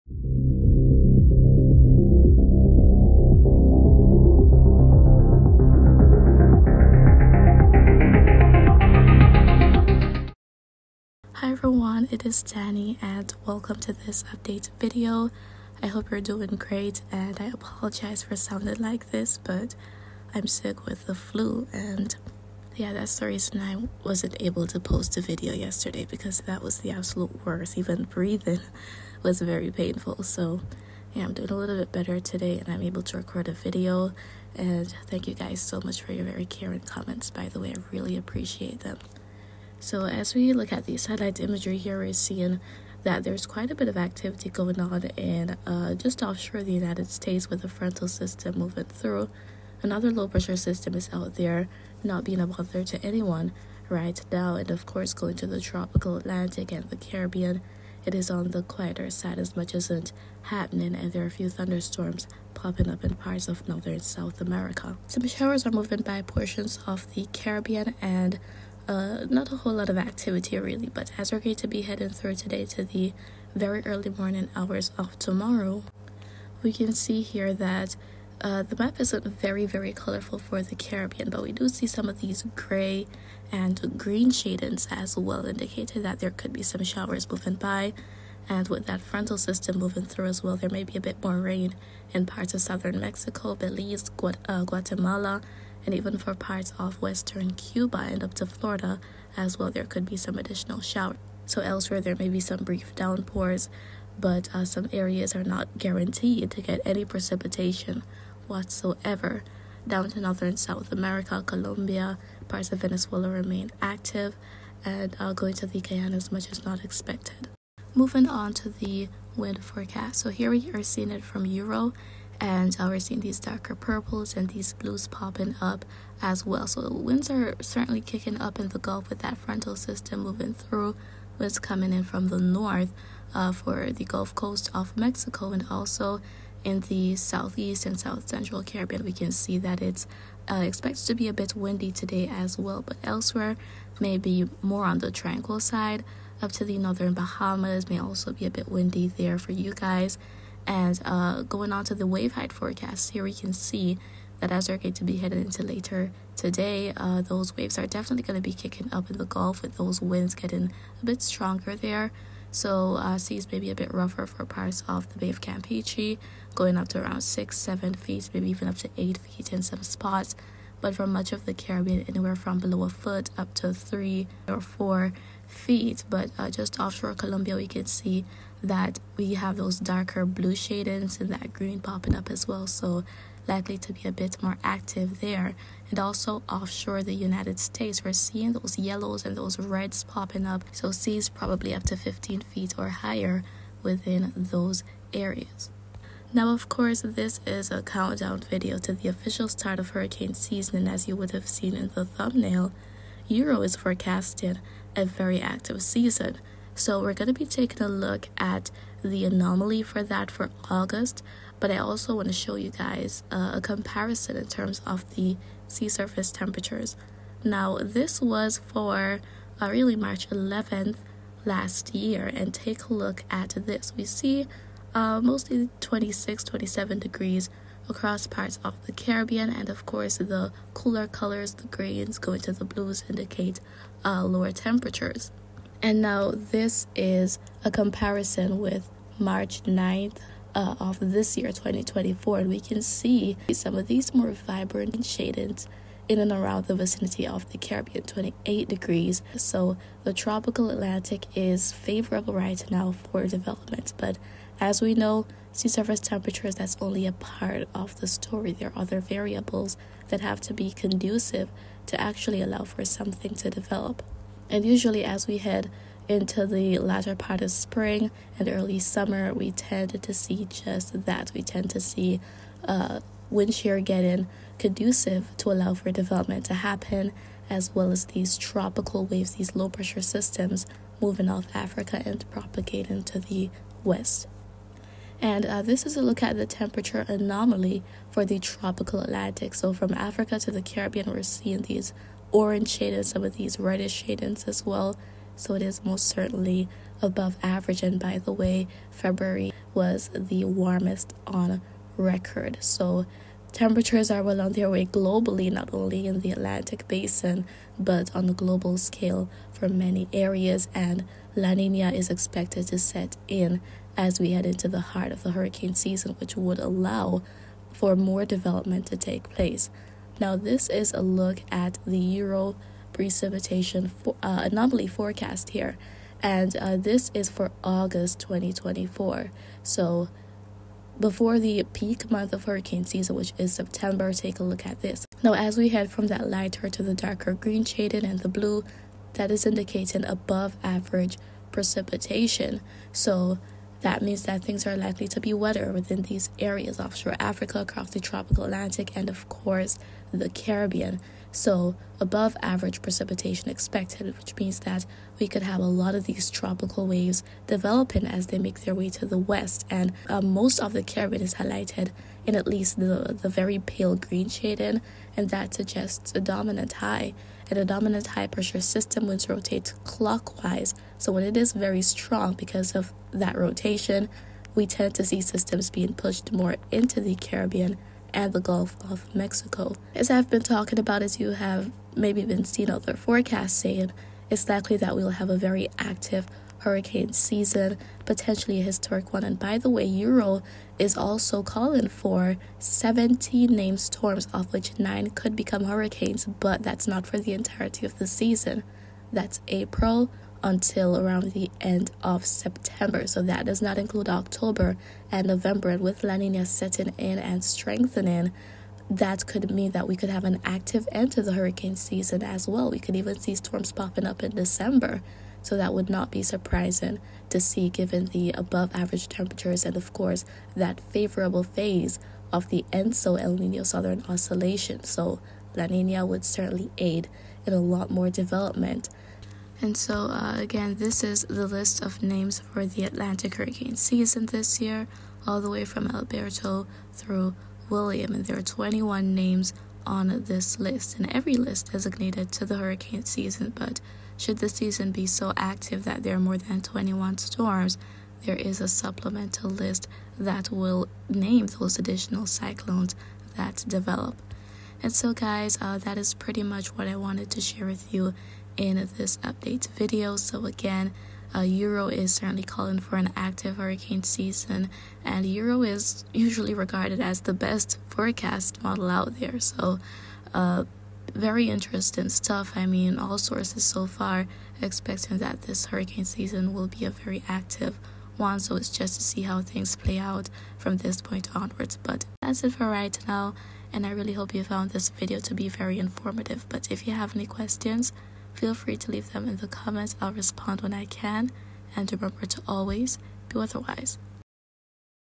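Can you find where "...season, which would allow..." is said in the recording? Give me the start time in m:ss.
5:15.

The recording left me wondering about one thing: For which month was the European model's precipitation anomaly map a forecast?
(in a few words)
August 2024.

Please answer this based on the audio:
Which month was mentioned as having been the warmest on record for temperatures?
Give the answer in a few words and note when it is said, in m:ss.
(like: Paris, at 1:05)
February, at 4:58.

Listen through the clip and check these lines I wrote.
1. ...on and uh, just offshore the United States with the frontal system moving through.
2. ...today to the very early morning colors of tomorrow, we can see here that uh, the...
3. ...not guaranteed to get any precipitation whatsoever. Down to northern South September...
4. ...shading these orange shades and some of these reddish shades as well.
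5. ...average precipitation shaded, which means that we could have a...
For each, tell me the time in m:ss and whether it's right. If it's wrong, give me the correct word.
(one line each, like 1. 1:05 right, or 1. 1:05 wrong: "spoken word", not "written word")
1. 0:44 right
2. 1:12 wrong: "hours", not "colors"
3. 1:45 wrong: "America", not "September"
4. 4:51 wrong: "seeing", not "shading"
5. 5:52 wrong: "expected", not "shaded".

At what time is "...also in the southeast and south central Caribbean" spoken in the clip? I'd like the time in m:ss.
2:15.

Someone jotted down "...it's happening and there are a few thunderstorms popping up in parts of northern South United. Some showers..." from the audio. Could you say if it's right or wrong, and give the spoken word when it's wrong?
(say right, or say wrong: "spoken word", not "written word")
wrong: "America", not "United".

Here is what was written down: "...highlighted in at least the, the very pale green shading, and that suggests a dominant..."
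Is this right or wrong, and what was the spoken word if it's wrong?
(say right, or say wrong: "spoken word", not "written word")
right.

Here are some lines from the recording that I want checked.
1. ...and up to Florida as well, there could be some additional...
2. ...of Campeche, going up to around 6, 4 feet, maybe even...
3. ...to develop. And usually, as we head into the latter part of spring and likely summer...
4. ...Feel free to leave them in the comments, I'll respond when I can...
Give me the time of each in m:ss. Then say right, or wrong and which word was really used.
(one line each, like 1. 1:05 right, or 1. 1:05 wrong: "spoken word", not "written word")
1. 1:38 right
2. 2:45 wrong: "7", not "4"
3. 4:23 wrong: "early", not "likely"
4. 8:08 right.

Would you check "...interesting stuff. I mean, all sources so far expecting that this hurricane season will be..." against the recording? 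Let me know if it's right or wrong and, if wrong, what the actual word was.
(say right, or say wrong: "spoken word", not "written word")
right.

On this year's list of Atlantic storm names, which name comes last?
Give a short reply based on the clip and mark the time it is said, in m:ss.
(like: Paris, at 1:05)
William, at 7:17.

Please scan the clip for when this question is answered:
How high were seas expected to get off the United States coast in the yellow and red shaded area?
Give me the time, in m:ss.
3:11.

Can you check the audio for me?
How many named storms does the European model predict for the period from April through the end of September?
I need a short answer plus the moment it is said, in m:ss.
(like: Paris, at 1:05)
17, at 6:32.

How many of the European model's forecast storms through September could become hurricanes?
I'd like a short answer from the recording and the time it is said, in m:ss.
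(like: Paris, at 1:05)
9, at 6:34.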